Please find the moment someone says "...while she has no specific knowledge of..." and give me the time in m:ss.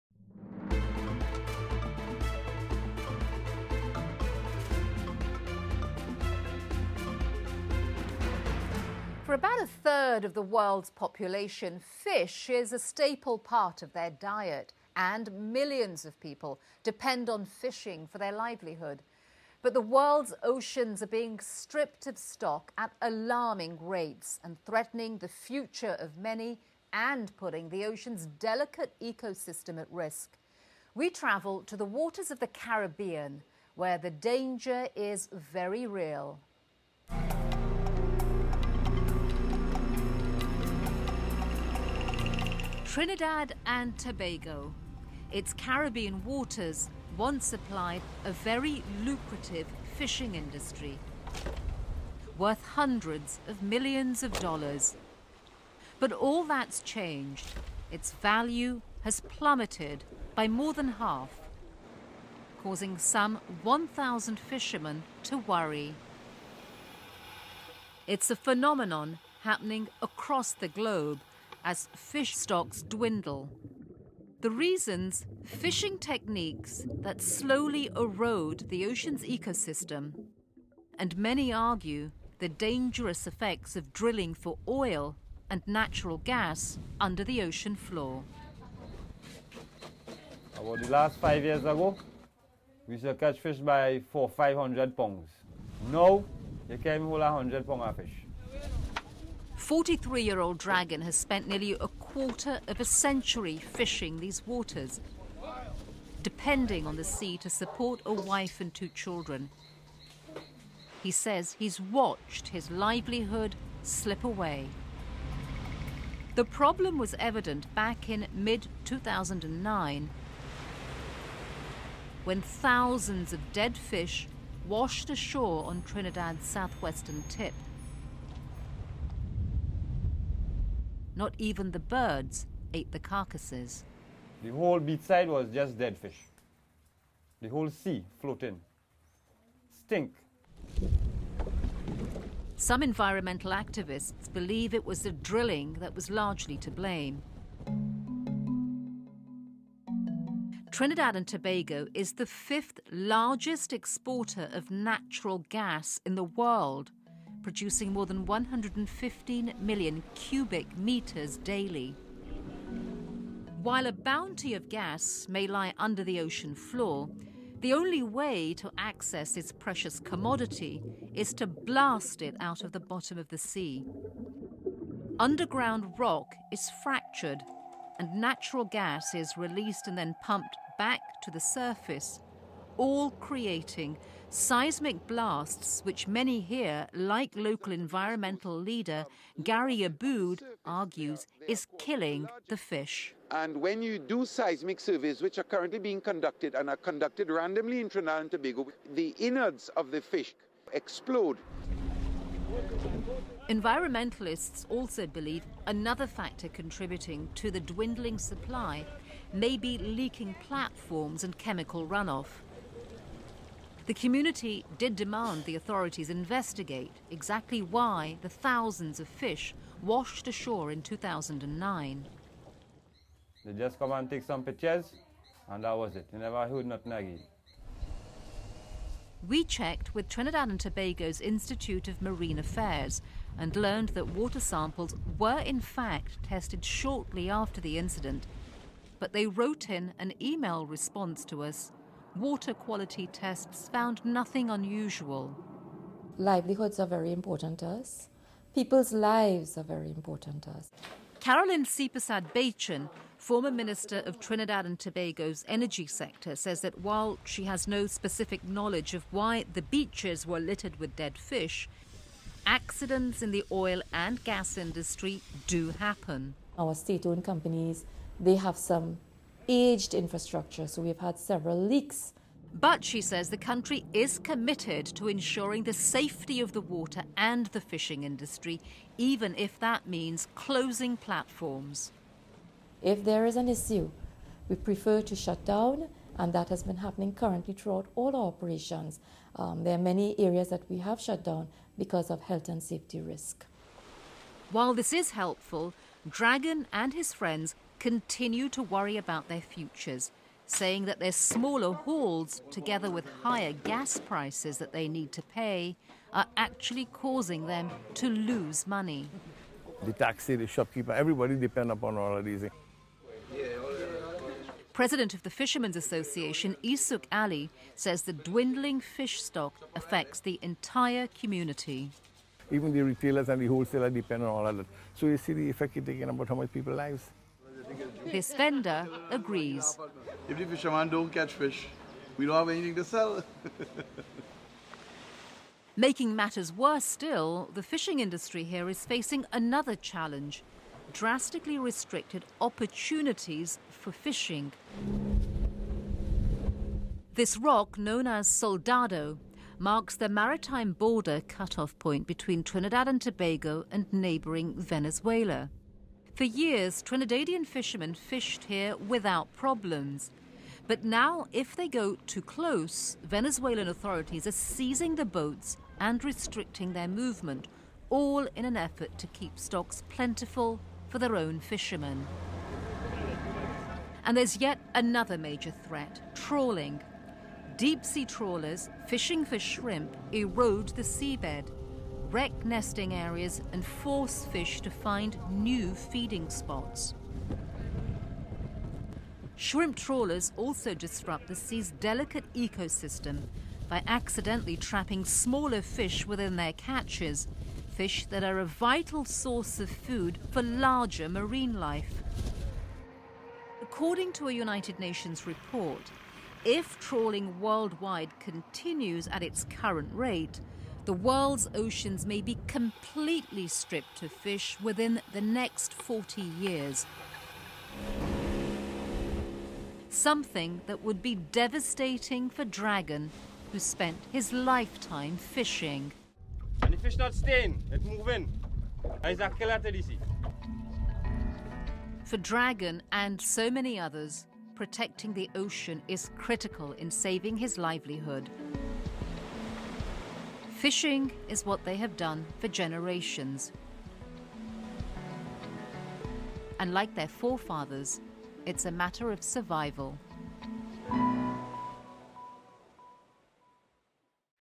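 4:16.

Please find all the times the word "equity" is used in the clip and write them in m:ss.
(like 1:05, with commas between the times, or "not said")
not said.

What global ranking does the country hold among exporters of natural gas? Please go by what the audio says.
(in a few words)
fifth largest.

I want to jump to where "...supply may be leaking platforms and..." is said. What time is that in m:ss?
3:28.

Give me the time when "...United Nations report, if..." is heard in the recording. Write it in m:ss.
6:44.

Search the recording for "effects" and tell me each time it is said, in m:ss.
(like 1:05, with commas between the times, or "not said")
1:23, 5:25.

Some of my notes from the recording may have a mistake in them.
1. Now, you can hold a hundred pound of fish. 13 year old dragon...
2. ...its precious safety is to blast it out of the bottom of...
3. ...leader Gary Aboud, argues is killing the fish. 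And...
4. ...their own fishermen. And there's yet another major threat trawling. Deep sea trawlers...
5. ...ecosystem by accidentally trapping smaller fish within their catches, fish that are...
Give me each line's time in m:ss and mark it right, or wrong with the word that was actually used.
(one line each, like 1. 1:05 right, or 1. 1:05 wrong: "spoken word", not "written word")
1. 1:35 wrong: "43", not "13"
2. 2:49 wrong: "commodity", not "safety"
3. 3:08 right
4. 6:10 right
5. 6:32 right.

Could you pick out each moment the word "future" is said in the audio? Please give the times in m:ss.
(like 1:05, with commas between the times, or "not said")
0:25, 4:59.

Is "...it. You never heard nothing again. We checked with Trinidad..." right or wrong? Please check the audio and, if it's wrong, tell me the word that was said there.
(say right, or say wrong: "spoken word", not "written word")
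right.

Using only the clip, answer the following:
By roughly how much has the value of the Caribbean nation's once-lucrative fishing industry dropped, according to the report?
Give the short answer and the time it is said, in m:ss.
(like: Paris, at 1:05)
more than half, at 1:00.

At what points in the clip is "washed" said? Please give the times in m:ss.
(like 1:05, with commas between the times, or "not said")
2:04, 3:39.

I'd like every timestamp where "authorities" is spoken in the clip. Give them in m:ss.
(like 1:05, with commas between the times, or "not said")
3:35, 6:03.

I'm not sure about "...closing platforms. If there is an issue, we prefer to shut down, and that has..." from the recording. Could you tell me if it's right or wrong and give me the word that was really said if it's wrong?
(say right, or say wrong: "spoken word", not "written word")
right.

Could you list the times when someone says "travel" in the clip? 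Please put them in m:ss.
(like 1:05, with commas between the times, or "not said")
0:31.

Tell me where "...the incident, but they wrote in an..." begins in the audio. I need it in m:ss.
3:57.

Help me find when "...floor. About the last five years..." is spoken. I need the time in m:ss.
1:27.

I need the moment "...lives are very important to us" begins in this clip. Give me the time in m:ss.
4:08.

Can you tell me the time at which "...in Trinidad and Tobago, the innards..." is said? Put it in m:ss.
3:17.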